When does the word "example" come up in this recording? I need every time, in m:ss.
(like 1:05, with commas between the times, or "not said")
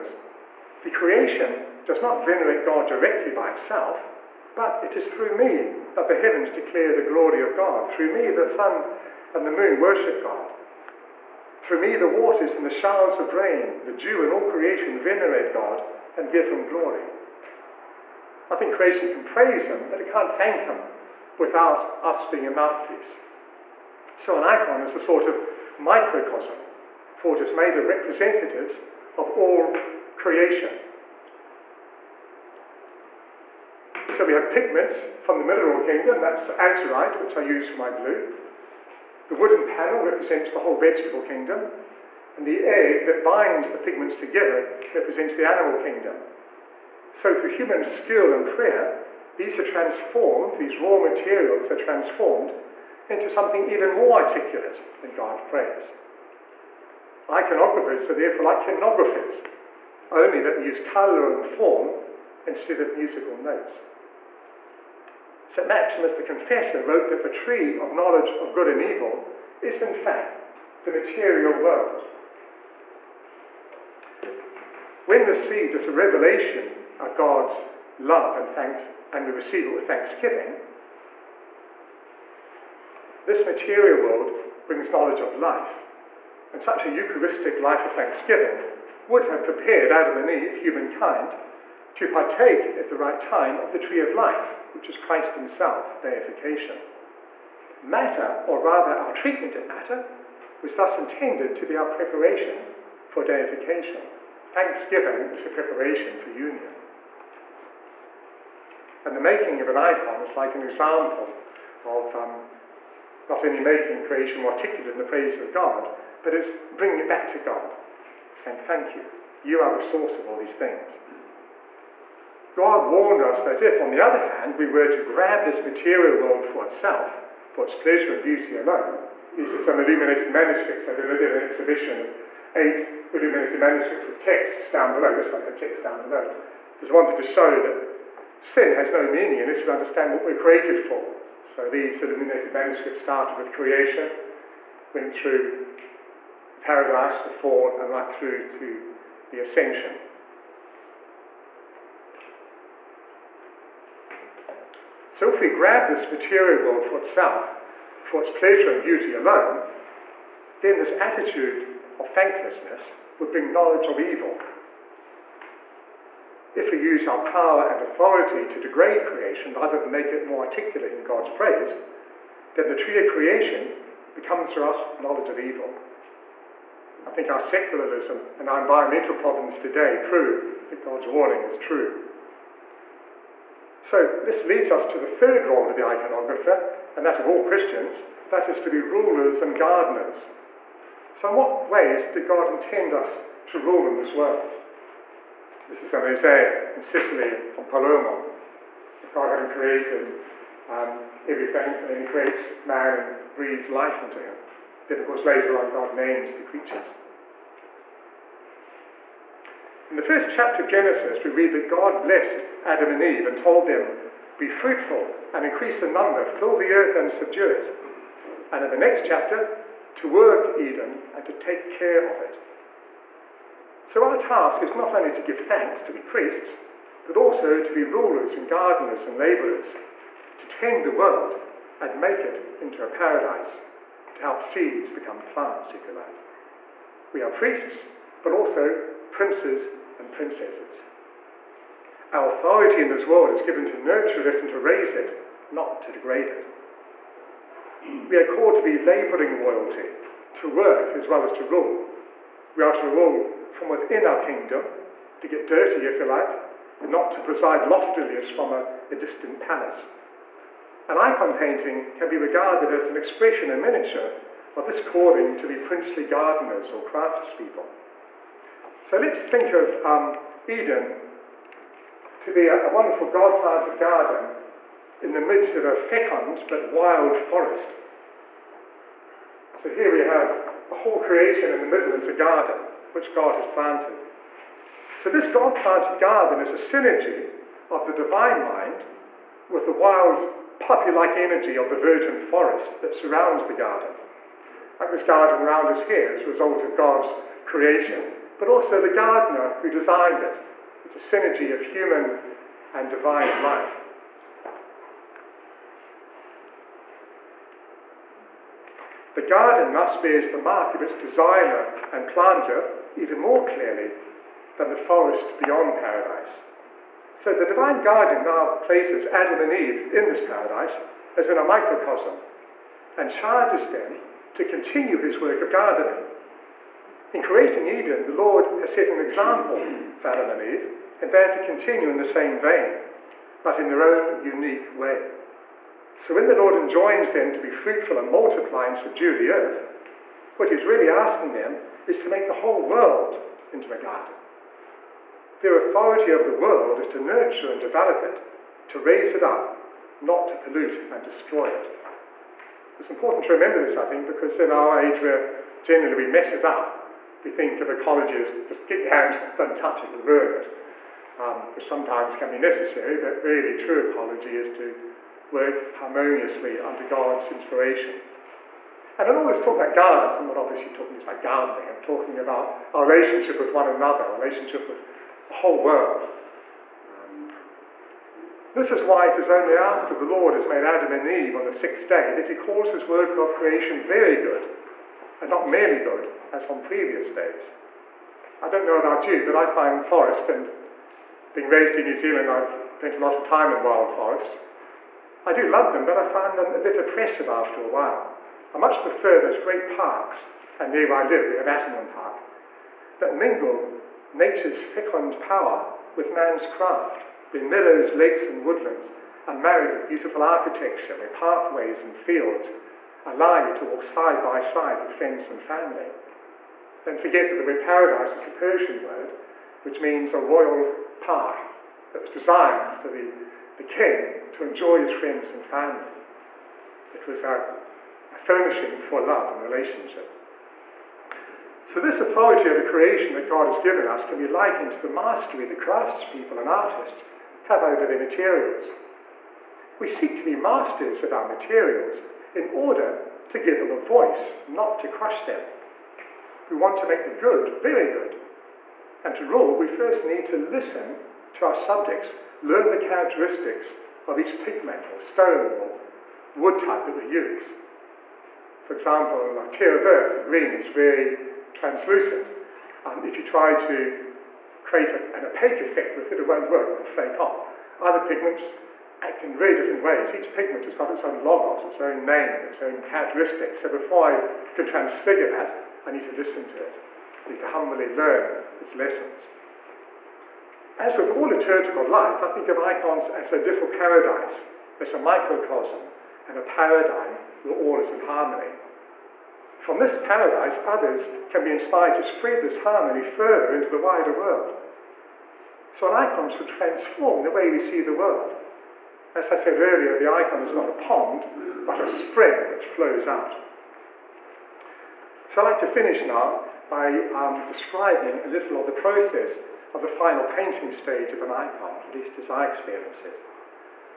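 1:50, 5:29, 7:38.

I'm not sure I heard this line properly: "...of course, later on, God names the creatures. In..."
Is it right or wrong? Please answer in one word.
right.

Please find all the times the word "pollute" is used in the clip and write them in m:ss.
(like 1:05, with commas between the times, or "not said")
5:50.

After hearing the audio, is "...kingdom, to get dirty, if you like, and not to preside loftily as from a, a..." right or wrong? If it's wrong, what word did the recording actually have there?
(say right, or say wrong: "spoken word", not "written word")
right.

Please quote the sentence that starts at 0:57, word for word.
Iconographers are therefore like hymnographers, only that we use colour and form instead of musical notes.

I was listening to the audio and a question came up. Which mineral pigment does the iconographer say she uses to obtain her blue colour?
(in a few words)
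Azurite.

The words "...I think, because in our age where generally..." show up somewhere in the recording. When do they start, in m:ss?
5:53.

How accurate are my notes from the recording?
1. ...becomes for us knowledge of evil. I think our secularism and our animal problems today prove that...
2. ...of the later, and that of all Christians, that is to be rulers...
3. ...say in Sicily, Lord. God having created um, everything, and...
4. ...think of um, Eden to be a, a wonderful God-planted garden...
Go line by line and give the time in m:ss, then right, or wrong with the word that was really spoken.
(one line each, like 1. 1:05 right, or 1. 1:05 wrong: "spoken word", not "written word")
1. 2:54 wrong: "environmental", not "animal"
2. 3:05 wrong: "iconographer", not "later"
3. 3:16 wrong: "Palermo", not "Lord"
4. 4:29 right.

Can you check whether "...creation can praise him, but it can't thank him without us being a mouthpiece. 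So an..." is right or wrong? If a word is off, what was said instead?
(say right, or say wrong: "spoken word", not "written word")
right.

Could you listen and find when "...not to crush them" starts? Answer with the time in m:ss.
7:24.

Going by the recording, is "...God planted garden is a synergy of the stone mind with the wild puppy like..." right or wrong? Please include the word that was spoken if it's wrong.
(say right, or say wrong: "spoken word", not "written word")
wrong: "divine", not "stone".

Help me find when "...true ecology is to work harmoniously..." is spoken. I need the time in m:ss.
6:03.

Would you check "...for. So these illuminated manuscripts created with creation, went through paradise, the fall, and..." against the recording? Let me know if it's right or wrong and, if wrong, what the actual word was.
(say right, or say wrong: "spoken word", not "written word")
wrong: "started", not "created".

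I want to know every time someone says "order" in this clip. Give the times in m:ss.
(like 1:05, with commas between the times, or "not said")
7:22.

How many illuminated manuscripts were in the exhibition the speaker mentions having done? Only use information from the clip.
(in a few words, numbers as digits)
8.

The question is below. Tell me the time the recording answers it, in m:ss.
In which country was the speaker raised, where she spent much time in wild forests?
6:31.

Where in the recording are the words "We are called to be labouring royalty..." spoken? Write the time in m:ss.
4:08.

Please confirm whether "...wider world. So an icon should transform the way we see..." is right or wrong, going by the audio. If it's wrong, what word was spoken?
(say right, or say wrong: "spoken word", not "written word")
right.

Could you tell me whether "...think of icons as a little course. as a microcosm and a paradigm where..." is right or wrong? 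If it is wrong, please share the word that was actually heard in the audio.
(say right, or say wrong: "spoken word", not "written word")
wrong: "paradise", not "course".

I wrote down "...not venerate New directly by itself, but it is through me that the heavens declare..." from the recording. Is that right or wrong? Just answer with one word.
wrong.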